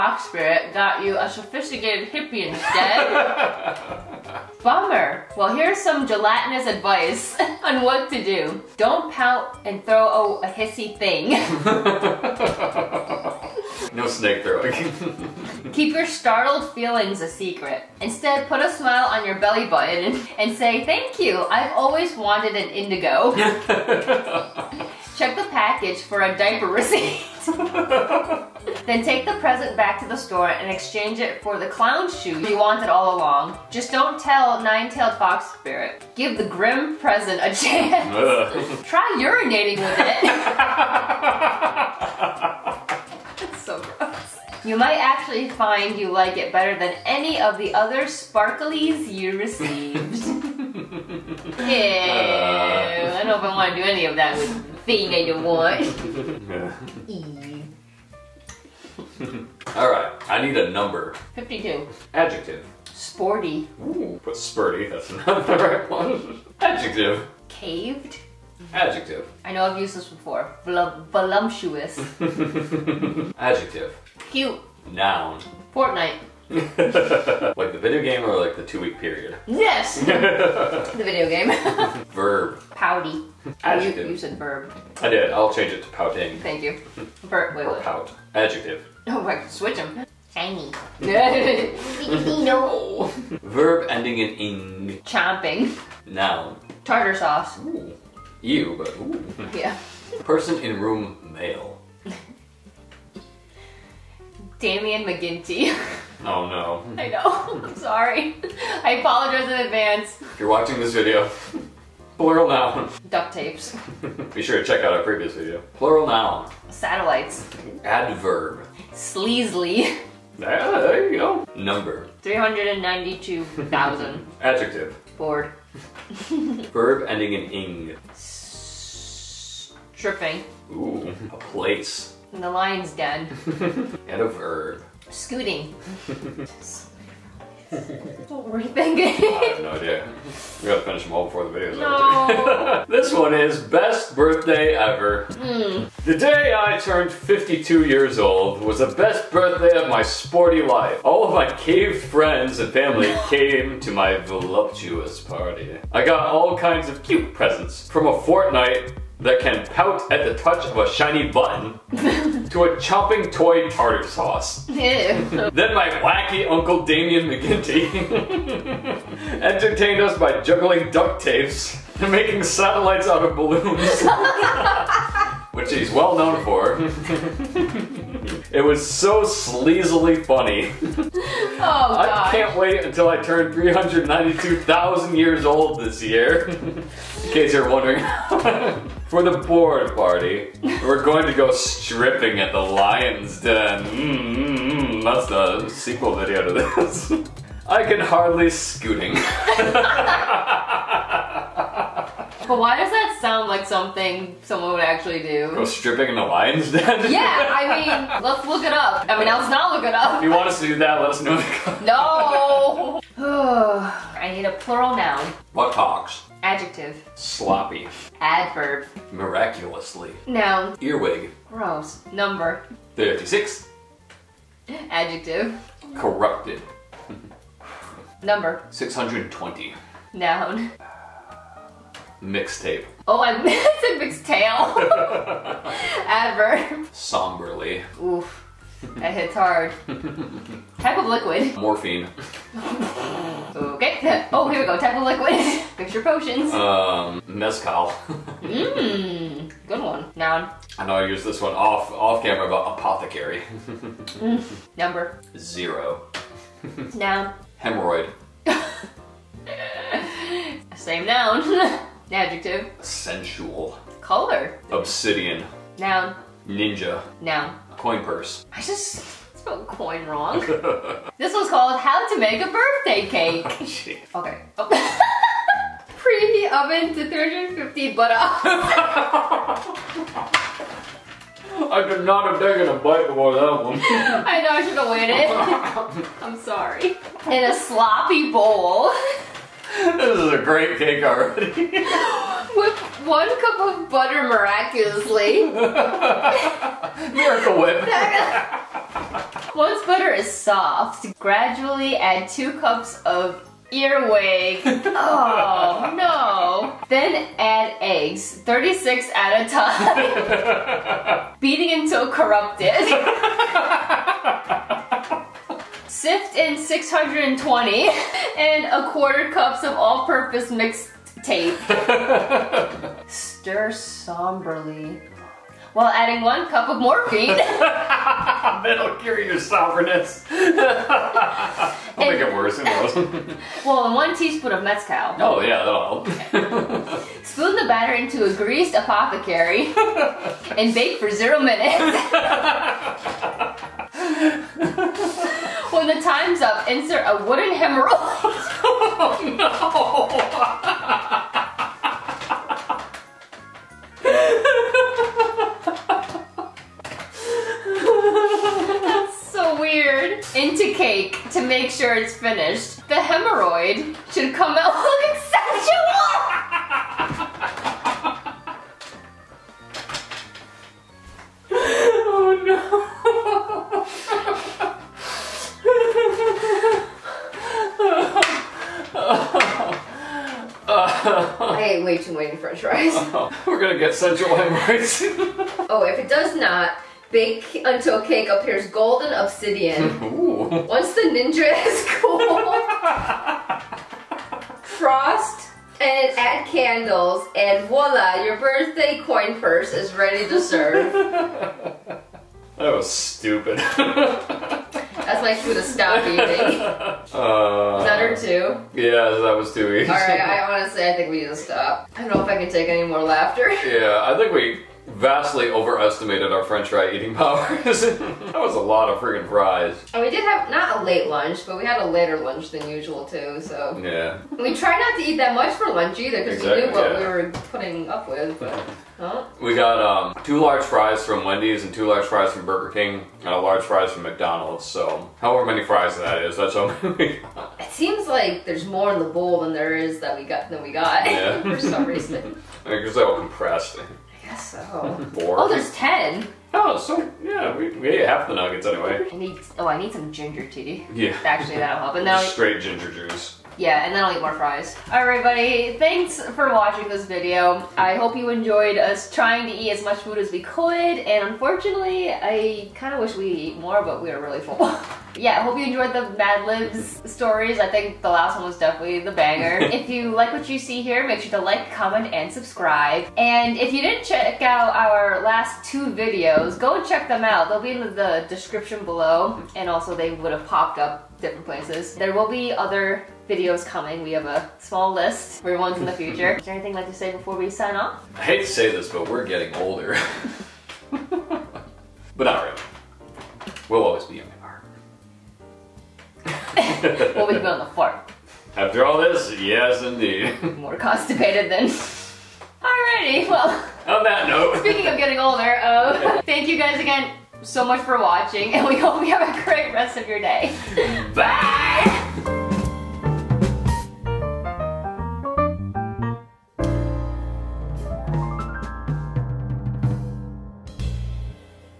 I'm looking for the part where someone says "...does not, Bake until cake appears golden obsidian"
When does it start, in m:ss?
6:26.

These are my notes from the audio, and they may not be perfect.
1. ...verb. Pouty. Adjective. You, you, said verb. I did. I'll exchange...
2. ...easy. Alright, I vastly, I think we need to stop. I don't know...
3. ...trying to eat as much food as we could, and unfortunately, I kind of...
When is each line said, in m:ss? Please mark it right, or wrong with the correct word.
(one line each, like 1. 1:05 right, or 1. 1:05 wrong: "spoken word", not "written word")
1. 1:22 wrong: "change", not "exchange"
2. 6:49 wrong: "honestly", not "vastly"
3. 7:39 right.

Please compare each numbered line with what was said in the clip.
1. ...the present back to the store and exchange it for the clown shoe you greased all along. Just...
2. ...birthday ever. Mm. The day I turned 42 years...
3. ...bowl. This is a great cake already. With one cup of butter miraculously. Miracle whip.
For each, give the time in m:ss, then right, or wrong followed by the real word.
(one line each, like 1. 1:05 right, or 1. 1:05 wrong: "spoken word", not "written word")
1. 0:29 wrong: "wanted", not "greased"
2. 2:24 wrong: "52", not "42"
3. 4:48 right.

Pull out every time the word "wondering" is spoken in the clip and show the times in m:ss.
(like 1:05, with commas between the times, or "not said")
3:07.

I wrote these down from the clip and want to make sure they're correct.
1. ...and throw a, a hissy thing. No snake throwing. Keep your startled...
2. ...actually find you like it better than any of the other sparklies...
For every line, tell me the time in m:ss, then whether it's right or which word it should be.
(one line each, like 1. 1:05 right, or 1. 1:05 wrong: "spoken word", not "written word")
1. 0:09 right
2. 0:44 right.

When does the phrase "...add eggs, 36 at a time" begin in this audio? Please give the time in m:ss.
5:07.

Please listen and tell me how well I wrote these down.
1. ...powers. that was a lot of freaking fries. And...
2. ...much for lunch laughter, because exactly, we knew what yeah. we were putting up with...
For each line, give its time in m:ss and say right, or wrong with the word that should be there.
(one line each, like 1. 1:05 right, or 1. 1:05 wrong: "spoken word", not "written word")
1. 6:57 right
2. 7:05 wrong: "either", not "laughter".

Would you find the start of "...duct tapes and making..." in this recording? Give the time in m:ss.
2:50.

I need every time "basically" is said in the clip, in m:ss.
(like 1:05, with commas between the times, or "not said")
not said.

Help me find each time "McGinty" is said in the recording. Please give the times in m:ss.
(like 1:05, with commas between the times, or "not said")
1:45, 2:47.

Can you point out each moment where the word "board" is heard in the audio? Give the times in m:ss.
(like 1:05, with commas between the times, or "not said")
3:09.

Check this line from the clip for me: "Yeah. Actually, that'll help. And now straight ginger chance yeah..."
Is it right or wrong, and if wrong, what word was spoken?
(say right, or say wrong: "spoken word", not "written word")
wrong: "juice", not "chance".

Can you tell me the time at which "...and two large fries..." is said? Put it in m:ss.
7:11.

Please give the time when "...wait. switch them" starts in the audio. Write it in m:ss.
1:29.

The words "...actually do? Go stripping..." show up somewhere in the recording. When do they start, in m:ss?
3:24.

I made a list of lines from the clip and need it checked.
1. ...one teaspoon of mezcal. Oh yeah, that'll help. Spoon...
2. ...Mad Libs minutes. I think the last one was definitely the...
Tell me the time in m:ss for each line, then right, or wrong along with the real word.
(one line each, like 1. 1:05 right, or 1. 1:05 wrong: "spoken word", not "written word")
1. 5:33 right
2. 7:46 wrong: "stories", not "minutes".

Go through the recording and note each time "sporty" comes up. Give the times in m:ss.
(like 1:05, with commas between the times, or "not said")
1:02, 2:30.